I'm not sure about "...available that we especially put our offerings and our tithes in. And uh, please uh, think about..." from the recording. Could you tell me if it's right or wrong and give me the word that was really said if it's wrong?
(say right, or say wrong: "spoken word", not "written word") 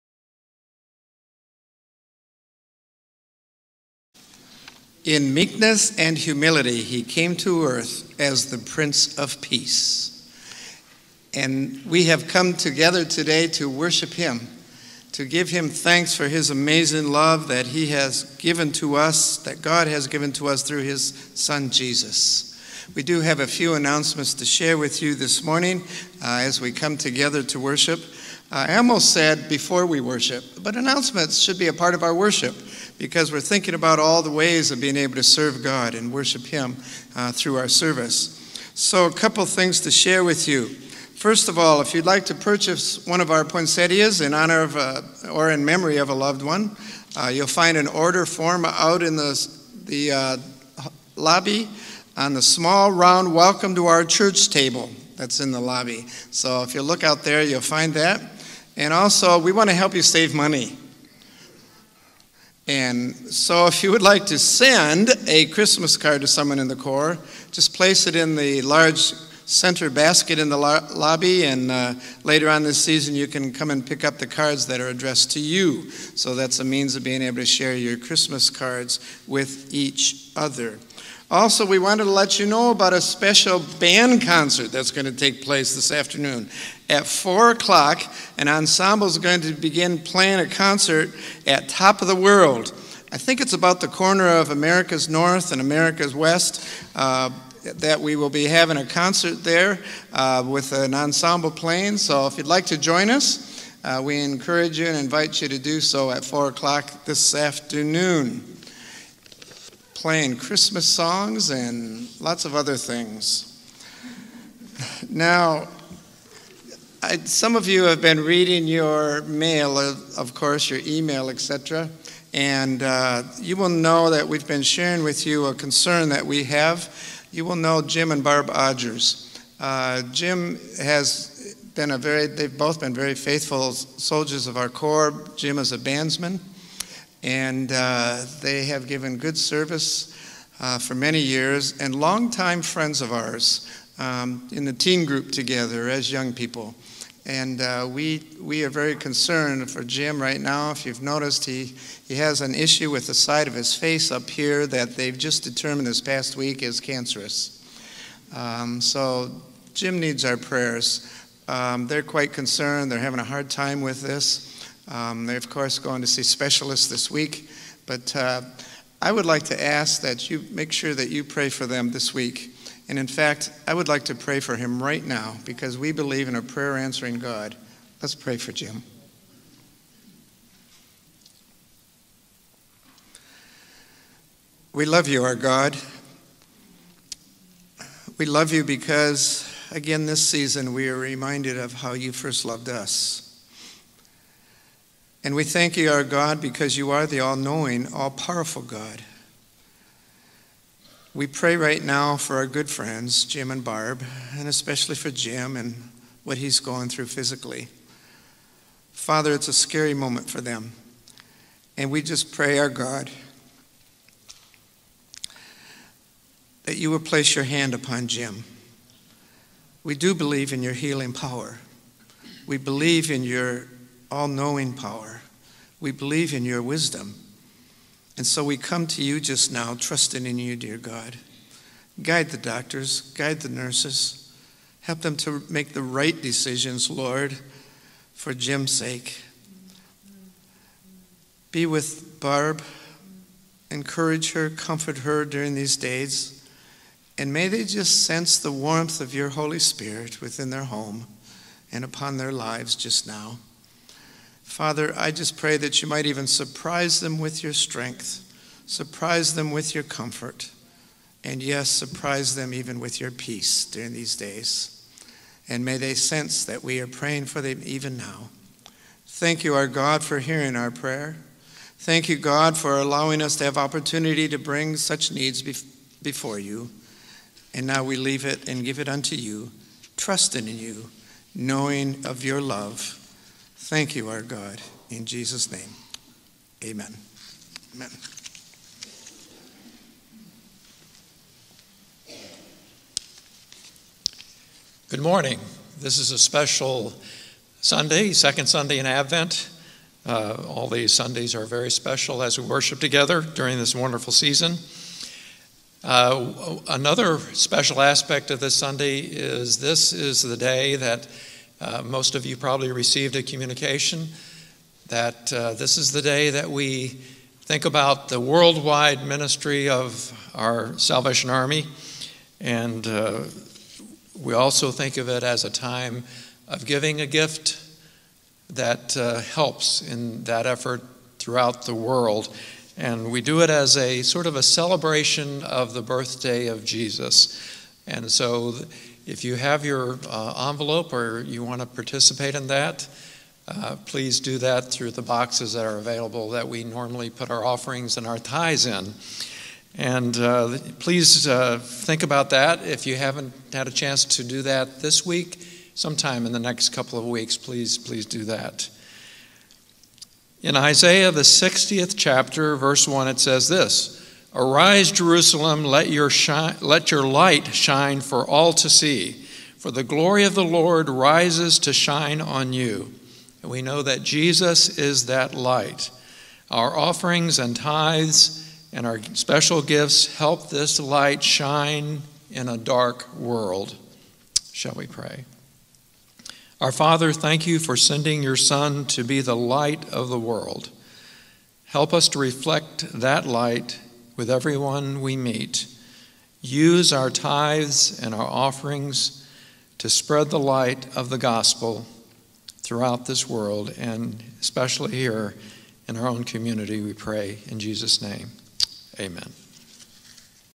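wrong: "normally", not "especially".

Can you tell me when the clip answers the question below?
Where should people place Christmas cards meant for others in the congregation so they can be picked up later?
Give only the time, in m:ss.
1:08.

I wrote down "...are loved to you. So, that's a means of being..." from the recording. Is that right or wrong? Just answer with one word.
wrong.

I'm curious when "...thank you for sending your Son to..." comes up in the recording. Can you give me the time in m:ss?
6:27.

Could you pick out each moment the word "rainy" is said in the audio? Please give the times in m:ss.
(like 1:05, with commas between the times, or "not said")
not said.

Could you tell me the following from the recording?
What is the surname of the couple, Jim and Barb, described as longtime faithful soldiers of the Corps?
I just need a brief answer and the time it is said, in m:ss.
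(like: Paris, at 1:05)
Odgers, at 2:08.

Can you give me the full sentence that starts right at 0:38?
So, a couple things to share with you.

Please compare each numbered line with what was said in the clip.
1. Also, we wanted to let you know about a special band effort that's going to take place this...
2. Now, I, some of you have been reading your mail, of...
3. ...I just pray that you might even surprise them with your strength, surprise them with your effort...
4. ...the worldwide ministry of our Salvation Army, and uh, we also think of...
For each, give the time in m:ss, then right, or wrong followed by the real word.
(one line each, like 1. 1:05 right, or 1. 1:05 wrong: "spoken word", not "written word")
1. 1:21 wrong: "concert", not "effort"
2. 1:55 right
3. 4:14 wrong: "comfort", not "effort"
4. 5:18 right.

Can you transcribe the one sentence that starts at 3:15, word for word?
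And we thank you, our God, because you are the all knowing, all powerful God.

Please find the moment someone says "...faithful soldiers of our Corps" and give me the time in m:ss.
2:13.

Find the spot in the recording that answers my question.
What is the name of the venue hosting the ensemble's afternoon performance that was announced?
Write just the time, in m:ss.
1:31.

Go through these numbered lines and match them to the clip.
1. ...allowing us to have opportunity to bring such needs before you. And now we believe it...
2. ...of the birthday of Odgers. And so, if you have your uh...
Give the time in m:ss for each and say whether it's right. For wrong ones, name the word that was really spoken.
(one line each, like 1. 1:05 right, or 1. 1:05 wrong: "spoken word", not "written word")
1. 4:32 wrong: "leave", not "believe"
2. 5:35 wrong: "Jesus", not "Odgers".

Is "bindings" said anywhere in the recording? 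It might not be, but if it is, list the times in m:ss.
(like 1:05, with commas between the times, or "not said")
not said.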